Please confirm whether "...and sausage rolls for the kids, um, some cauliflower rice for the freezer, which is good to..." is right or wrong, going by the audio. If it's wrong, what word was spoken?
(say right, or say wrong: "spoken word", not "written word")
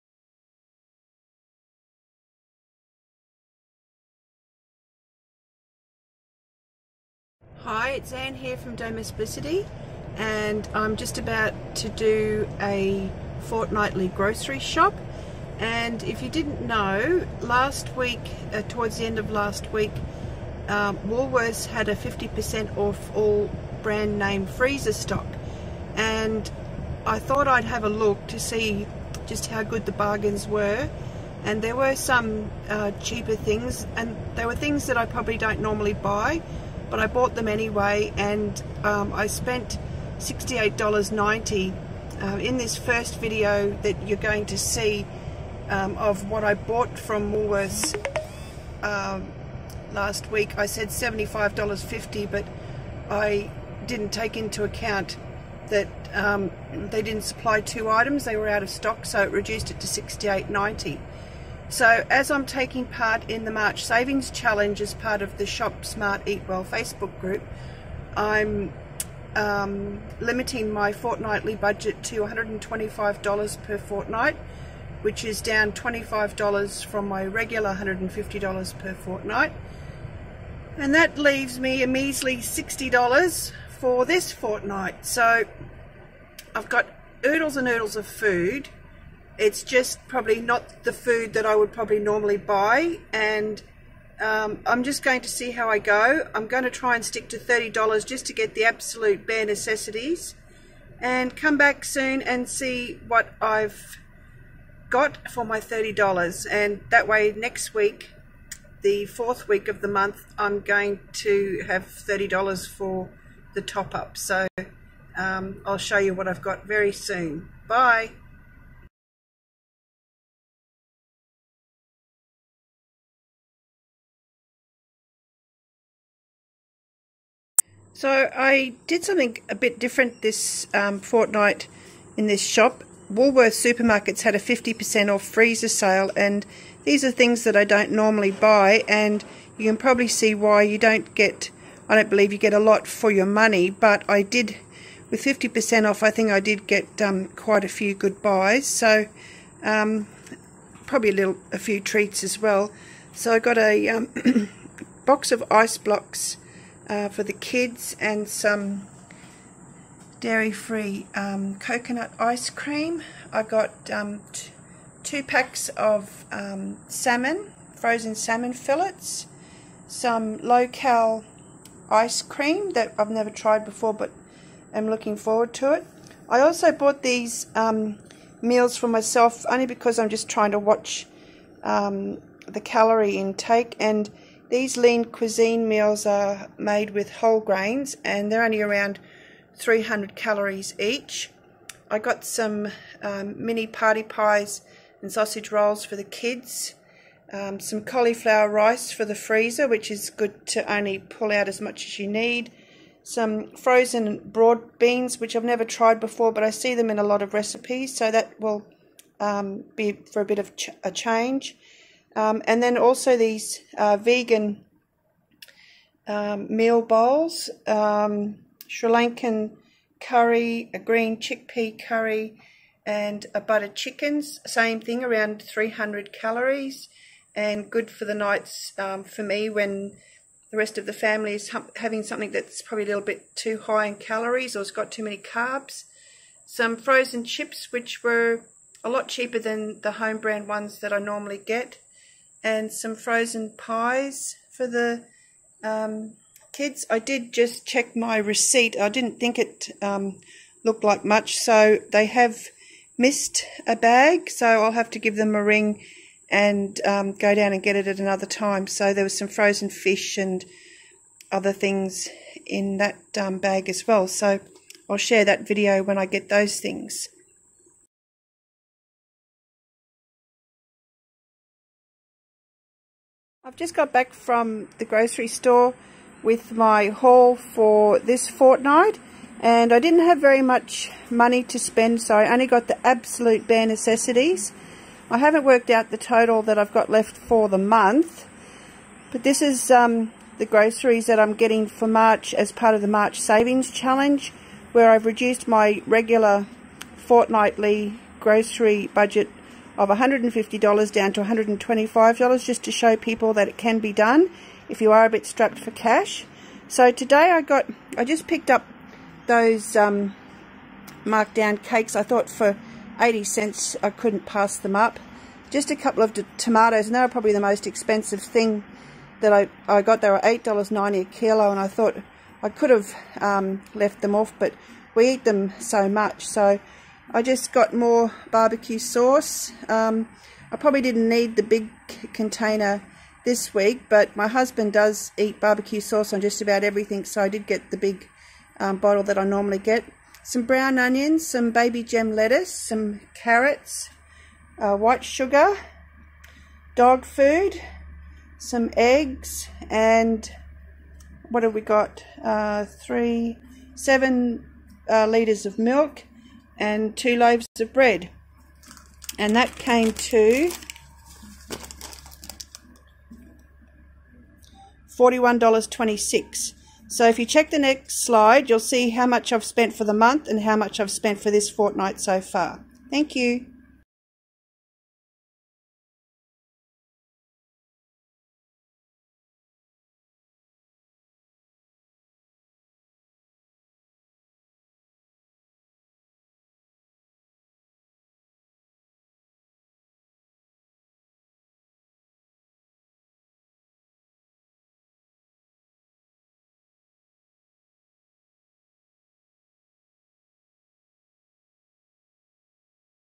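right.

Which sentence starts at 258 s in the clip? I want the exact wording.
So there was some frozen fish and other things in that um, bag as well.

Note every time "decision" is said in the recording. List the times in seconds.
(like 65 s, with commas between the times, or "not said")
not said.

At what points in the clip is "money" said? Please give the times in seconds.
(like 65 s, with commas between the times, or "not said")
143 s, 281 s.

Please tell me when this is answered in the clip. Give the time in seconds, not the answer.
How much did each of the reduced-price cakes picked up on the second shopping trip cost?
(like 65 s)
312 s.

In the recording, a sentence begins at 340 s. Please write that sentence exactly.
Some brown onions, some baby gem lettuce, some carrots, uh, white sugar, dog food, some eggs, and what have we got?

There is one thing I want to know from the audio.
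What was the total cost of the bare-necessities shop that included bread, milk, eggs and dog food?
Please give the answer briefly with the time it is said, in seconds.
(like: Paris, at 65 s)
$41.26, at 364 s.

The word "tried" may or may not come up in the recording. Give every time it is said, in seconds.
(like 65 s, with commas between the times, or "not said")
173 s, 205 s.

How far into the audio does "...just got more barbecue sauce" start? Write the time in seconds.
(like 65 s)
327 s.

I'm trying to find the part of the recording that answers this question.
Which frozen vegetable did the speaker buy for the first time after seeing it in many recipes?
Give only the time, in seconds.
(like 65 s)
204 s.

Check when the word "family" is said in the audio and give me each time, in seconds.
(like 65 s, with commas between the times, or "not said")
230 s.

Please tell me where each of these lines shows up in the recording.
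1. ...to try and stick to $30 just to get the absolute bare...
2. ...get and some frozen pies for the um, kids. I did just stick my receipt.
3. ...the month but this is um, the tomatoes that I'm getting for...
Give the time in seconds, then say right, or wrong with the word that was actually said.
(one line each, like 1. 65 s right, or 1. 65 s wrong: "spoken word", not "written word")
1. 96 s right
2. 241 s wrong: "check", not "stick"
3. 287 s wrong: "groceries", not "tomatoes".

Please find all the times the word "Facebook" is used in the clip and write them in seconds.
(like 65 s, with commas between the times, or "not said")
66 s.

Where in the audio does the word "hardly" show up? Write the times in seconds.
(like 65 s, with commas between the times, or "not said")
not said.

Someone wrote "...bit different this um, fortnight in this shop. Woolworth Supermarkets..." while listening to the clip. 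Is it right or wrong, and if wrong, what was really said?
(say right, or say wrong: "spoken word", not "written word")
right.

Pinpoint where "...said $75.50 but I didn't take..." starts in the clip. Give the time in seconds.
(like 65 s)
50 s.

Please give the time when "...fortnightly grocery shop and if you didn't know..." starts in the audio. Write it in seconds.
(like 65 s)
13 s.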